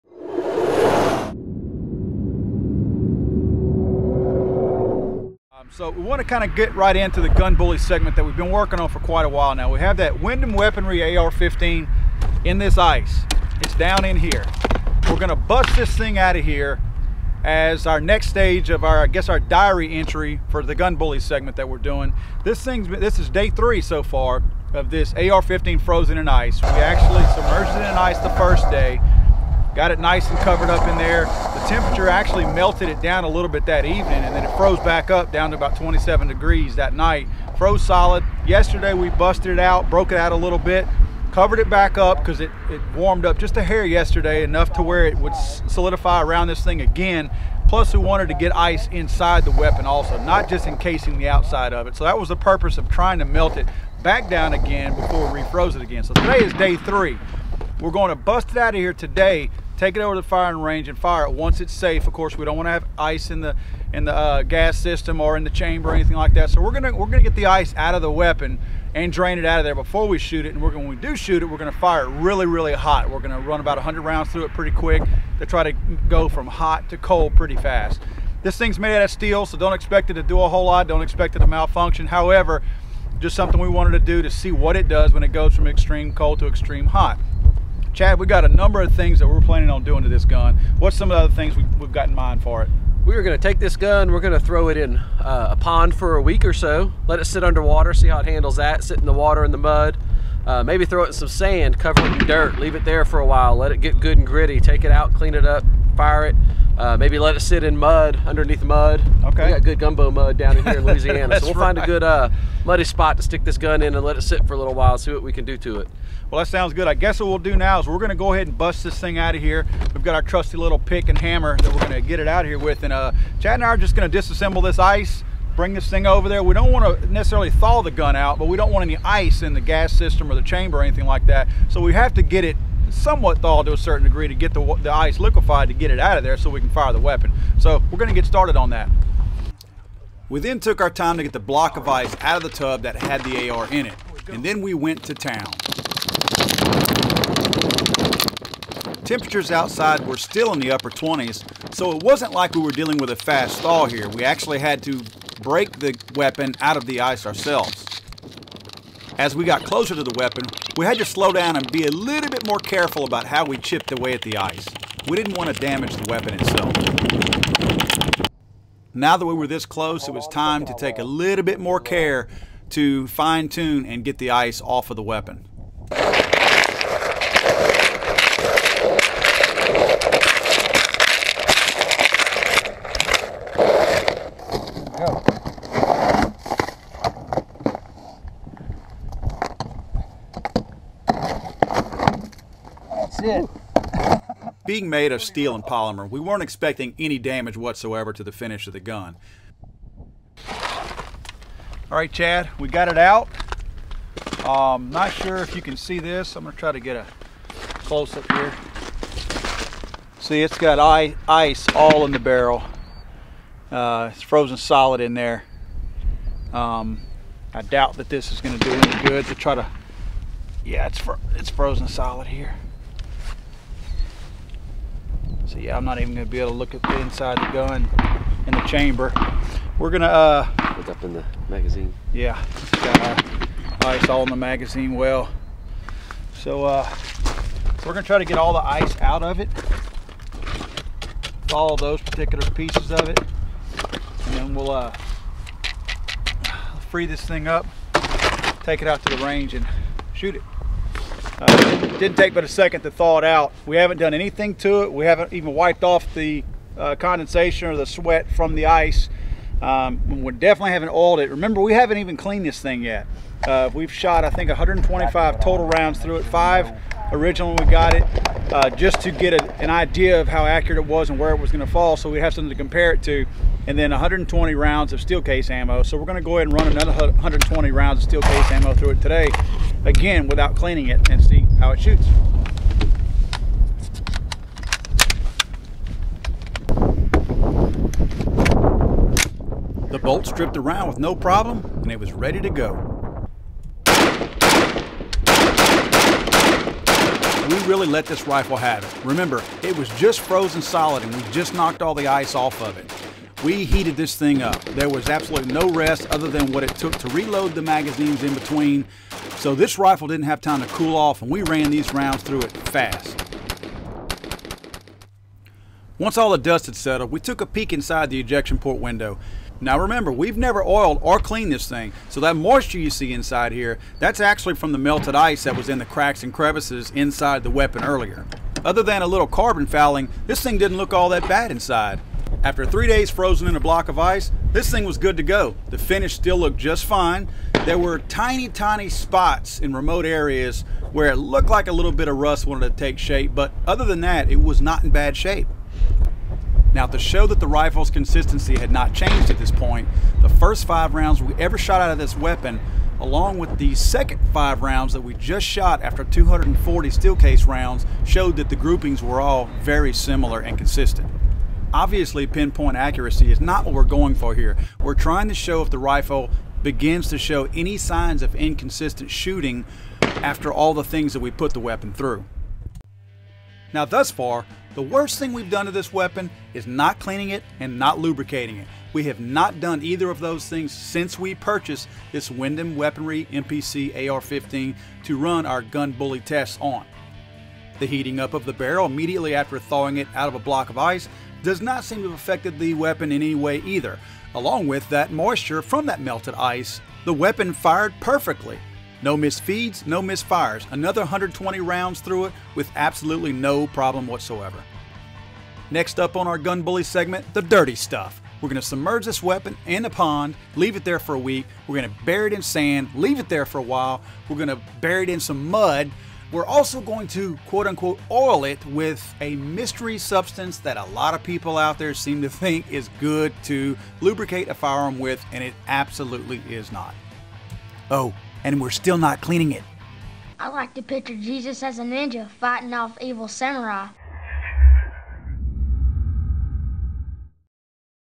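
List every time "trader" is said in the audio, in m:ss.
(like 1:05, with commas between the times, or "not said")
not said.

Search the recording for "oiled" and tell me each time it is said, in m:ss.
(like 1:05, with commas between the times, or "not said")
4:20, 5:20.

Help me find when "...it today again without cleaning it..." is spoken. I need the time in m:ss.
4:38.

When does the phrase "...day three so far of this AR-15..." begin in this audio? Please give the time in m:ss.
0:23.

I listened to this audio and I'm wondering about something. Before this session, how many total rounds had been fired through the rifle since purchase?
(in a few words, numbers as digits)
125.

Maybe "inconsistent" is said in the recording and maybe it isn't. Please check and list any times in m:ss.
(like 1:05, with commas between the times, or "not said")
6:08.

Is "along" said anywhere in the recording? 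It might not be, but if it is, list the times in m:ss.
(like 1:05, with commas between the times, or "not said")
5:53, 6:34.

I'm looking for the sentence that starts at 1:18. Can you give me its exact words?
This thing's made out of steel, so don't expect it to do a whole lot.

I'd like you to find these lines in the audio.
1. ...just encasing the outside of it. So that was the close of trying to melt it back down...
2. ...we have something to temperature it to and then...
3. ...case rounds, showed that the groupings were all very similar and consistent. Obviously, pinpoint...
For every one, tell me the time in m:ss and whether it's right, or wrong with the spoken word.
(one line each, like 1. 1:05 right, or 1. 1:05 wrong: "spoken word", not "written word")
1. 0:50 wrong: "purpose", not "close"
2. 4:32 wrong: "compare", not "temperature"
3. 5:57 right.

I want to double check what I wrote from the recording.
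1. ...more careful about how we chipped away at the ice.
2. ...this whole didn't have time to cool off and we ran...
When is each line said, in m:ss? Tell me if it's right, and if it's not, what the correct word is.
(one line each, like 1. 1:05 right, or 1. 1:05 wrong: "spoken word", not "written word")
1. 2:42 right
2. 5:09 wrong: "rifle", not "whole".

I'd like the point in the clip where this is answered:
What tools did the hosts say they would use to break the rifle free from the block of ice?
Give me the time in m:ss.
2:00.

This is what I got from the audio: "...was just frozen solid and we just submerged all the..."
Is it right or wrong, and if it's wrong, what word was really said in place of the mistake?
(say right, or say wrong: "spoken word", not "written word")
wrong: "knocked", not "submerged".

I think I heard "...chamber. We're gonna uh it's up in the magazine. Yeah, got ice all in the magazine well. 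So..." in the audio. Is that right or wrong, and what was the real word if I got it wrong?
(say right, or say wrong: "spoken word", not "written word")
right.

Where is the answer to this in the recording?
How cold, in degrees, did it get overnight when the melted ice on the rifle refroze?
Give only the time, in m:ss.
0:35.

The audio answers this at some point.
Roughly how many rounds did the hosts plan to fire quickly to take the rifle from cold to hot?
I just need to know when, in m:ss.
1:13.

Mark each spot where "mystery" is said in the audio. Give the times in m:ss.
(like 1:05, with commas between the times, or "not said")
6:59.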